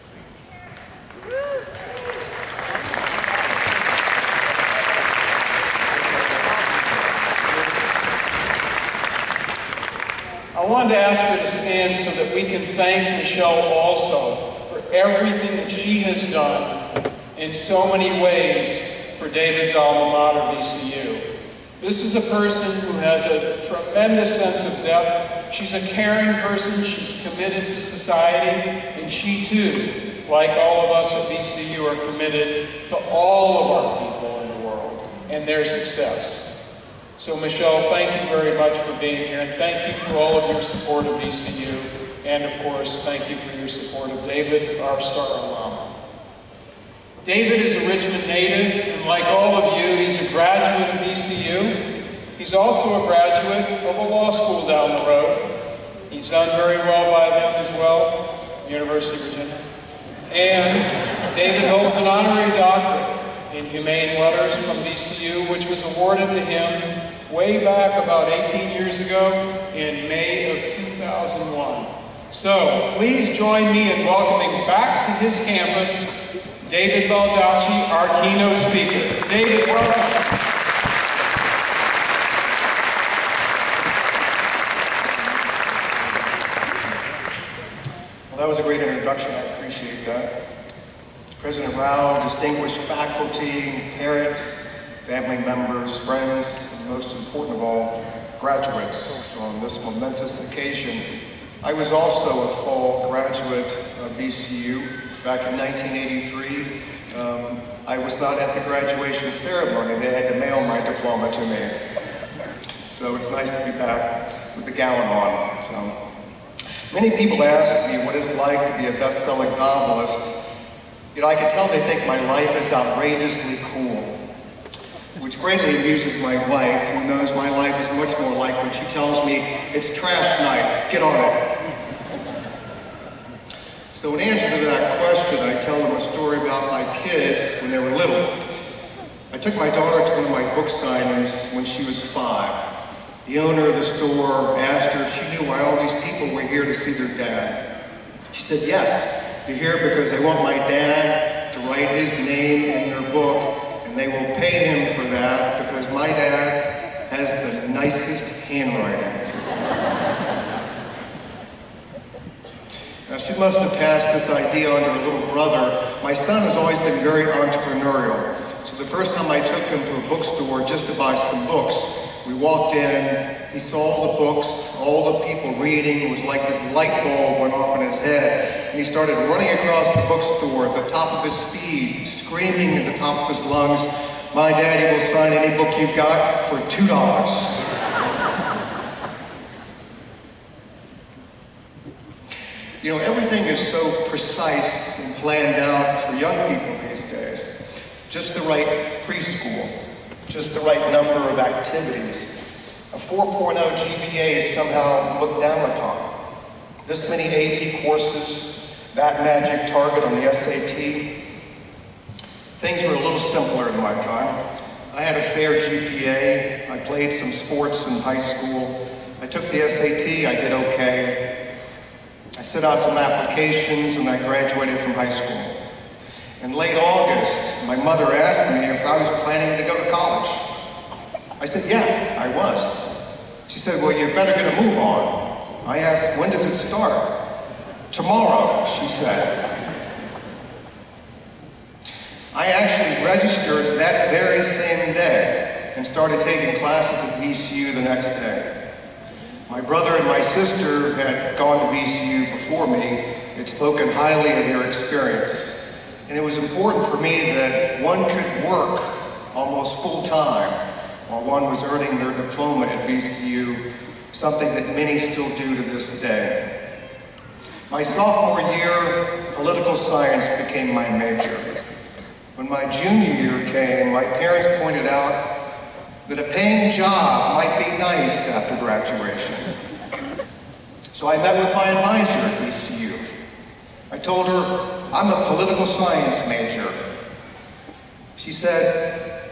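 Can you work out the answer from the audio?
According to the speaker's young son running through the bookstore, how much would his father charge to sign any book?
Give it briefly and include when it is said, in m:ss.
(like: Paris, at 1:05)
$2, at 3:06.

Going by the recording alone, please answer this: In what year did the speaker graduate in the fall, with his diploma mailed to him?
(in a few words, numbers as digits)
1983.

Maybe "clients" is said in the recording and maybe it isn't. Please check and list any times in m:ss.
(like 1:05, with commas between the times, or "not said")
not said.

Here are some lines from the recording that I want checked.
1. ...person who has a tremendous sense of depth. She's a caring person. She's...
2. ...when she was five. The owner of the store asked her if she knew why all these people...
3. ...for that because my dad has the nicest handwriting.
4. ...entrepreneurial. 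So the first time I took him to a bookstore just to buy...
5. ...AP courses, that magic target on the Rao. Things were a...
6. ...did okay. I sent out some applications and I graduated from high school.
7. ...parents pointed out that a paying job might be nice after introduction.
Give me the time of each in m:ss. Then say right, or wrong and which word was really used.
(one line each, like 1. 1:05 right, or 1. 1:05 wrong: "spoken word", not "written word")
1. 0:22 right
2. 2:21 right
3. 2:34 right
4. 2:47 right
5. 3:27 wrong: "SAT", not "Rao"
6. 3:40 right
7. 4:34 wrong: "graduation", not "introduction".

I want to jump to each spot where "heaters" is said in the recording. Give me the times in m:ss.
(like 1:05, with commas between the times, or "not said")
not said.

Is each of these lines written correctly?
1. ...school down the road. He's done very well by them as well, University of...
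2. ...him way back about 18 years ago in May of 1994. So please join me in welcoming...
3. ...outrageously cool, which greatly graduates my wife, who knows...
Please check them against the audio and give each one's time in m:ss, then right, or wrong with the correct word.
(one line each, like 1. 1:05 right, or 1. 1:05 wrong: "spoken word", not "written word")
1. 0:54 right
2. 1:06 wrong: "2001", not "1994"
3. 2:02 wrong: "amuses", not "graduates".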